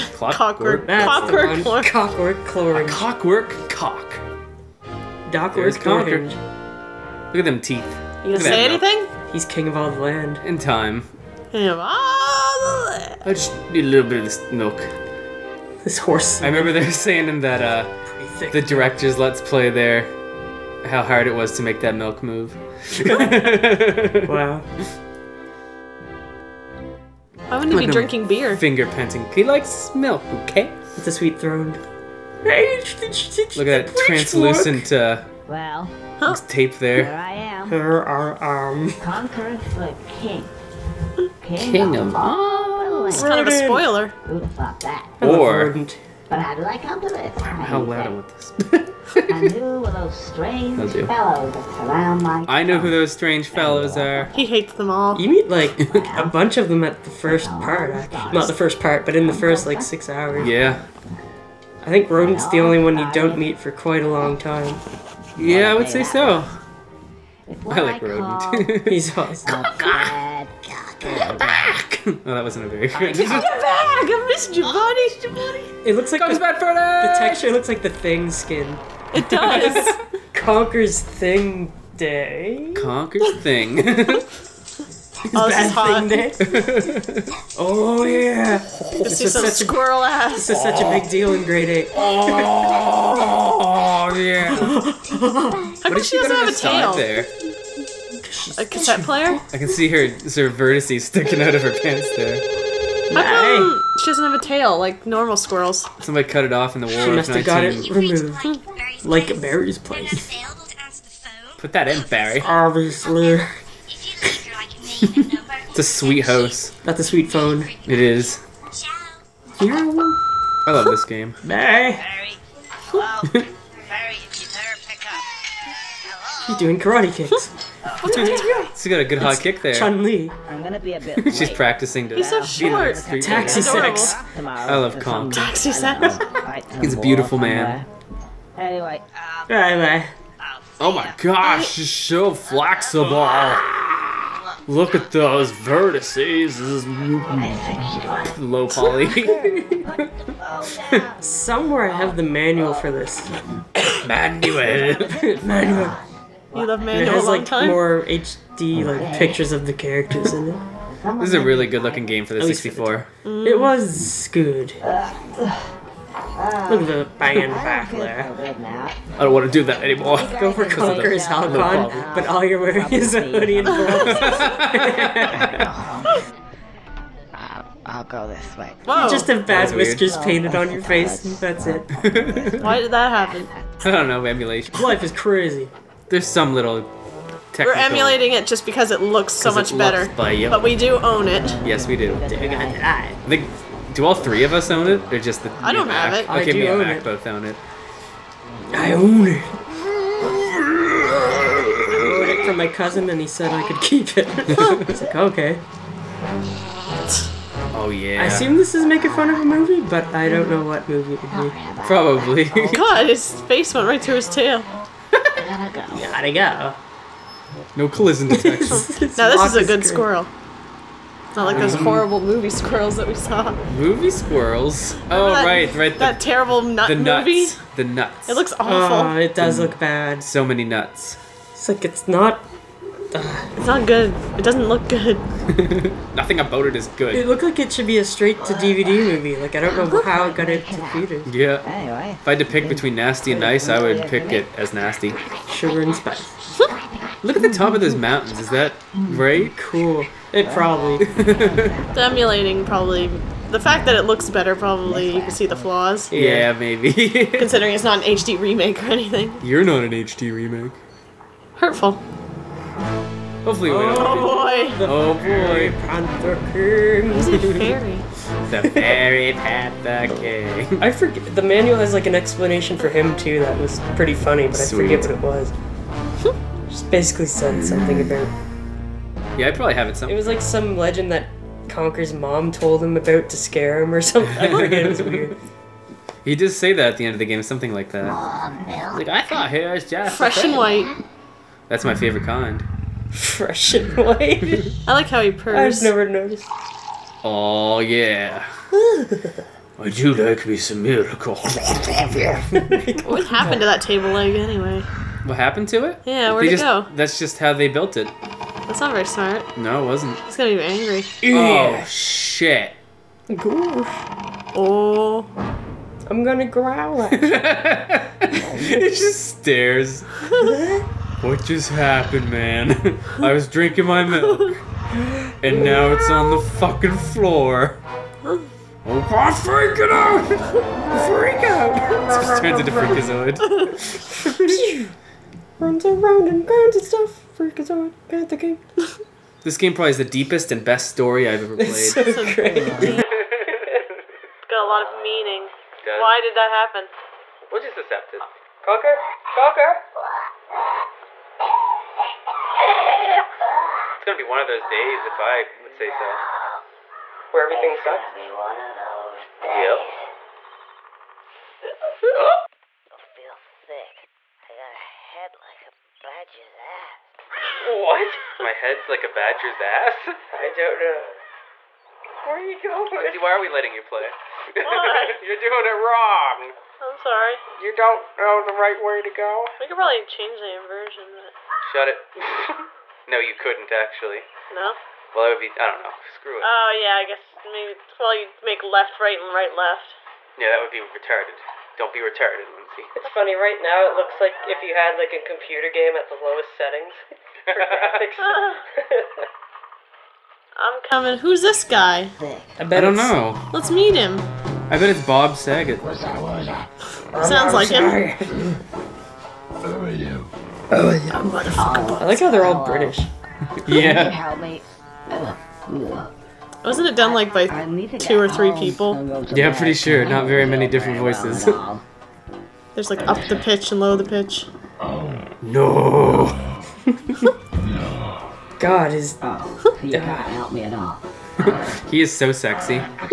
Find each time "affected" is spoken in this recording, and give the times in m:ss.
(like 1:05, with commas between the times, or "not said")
not said.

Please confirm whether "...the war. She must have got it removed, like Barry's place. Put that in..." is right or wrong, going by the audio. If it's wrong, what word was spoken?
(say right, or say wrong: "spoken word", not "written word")
right.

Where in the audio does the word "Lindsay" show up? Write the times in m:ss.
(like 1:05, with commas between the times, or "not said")
6:13, 6:32.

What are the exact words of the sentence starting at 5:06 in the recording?
That's just how they built it.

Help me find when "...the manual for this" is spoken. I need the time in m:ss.
2:32.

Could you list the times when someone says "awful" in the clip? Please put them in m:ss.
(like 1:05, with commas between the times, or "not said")
3:48.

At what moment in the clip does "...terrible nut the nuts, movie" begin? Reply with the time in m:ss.
3:46.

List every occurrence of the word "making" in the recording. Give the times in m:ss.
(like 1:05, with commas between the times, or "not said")
3:28.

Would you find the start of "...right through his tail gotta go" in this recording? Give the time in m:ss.
3:33.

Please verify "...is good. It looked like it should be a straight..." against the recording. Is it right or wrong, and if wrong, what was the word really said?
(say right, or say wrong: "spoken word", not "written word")
right.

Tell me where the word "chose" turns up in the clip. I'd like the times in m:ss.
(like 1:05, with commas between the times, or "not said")
not said.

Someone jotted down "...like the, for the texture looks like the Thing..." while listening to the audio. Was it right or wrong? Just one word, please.
right.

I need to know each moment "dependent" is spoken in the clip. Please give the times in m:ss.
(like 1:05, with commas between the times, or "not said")
not said.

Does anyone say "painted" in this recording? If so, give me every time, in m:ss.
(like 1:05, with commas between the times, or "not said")
3:00.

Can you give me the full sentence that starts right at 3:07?
We're emulating it just because it looks so much better.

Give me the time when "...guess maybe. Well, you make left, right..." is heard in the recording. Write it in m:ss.
6:27.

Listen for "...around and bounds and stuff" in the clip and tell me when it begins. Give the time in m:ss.
5:35.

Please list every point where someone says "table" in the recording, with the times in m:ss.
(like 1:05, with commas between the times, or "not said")
5:03.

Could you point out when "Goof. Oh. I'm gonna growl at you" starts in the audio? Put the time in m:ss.
5:13.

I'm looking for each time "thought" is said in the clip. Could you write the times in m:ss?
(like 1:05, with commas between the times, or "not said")
0:44, 4:49.